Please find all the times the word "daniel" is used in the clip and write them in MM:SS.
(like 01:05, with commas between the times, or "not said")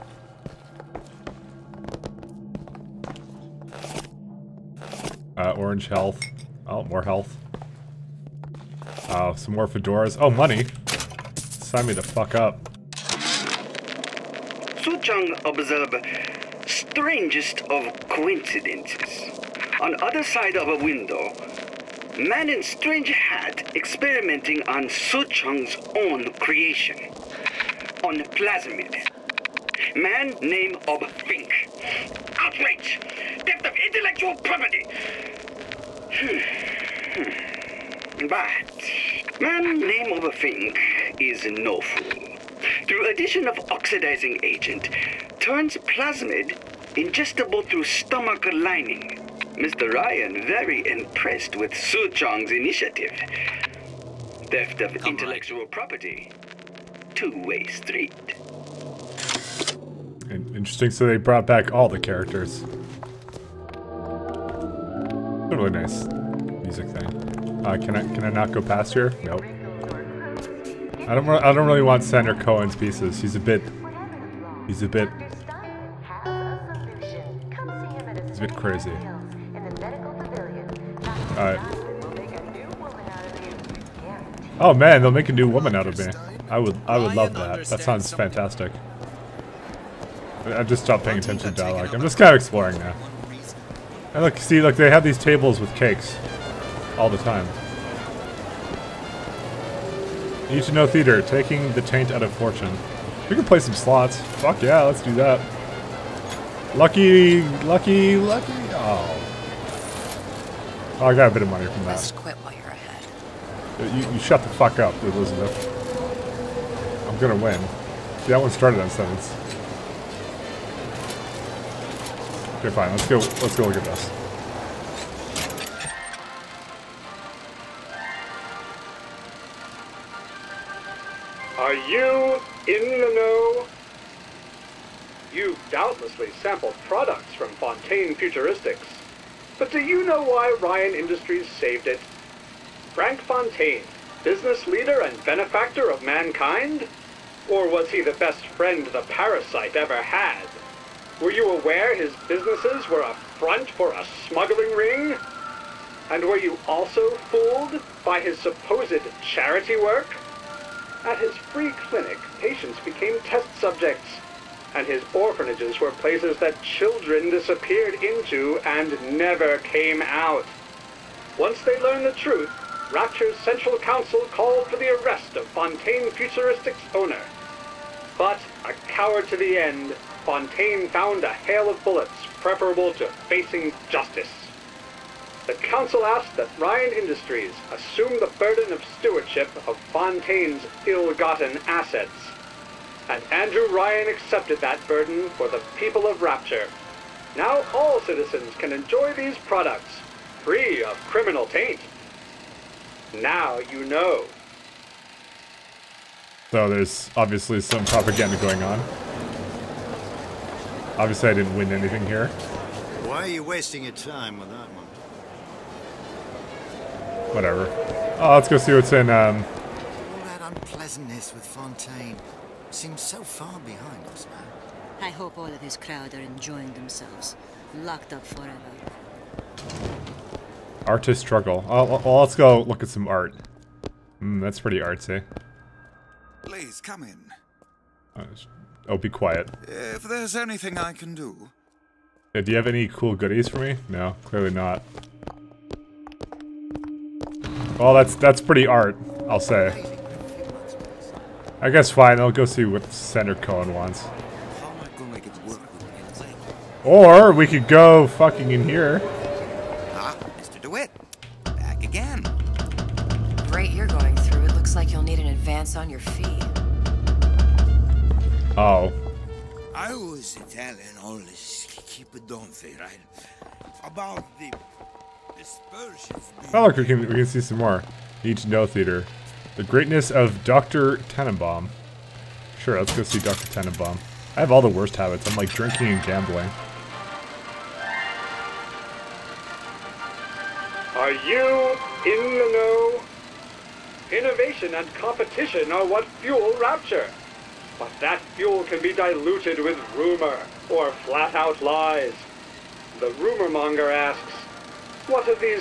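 not said.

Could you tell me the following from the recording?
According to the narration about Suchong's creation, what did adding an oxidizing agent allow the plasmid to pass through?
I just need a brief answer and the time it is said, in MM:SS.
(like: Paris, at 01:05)
stomach lining, at 00:47.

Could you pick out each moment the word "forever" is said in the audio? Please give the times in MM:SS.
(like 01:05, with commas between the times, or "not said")
03:48.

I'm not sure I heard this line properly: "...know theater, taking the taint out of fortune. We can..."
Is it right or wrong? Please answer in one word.
right.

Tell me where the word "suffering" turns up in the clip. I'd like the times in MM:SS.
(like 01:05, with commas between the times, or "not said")
not said.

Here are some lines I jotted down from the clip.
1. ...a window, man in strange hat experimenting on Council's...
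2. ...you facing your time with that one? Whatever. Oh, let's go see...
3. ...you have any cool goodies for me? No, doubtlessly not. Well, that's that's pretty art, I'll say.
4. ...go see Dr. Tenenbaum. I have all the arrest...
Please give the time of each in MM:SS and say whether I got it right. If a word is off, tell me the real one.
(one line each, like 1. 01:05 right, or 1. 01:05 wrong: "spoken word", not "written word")
1. 00:20 wrong: "Suchong", not "Council"
2. 03:33 wrong: "wasting", not "facing"
3. 04:02 wrong: "clearly", not "doubtlessly"
4. 04:42 wrong: "worst", not "arrest".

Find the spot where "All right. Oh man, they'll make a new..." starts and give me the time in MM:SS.
01:21.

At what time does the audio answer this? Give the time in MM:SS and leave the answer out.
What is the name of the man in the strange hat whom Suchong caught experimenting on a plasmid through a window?
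00:31.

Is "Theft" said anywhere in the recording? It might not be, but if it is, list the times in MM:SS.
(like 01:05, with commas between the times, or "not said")
00:33, 00:54.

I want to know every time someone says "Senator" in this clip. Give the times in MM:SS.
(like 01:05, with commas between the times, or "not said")
01:12, 04:12.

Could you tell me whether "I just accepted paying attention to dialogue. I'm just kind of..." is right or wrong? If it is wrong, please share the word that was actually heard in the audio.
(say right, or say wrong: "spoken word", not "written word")
wrong: "stopped", not "accepted".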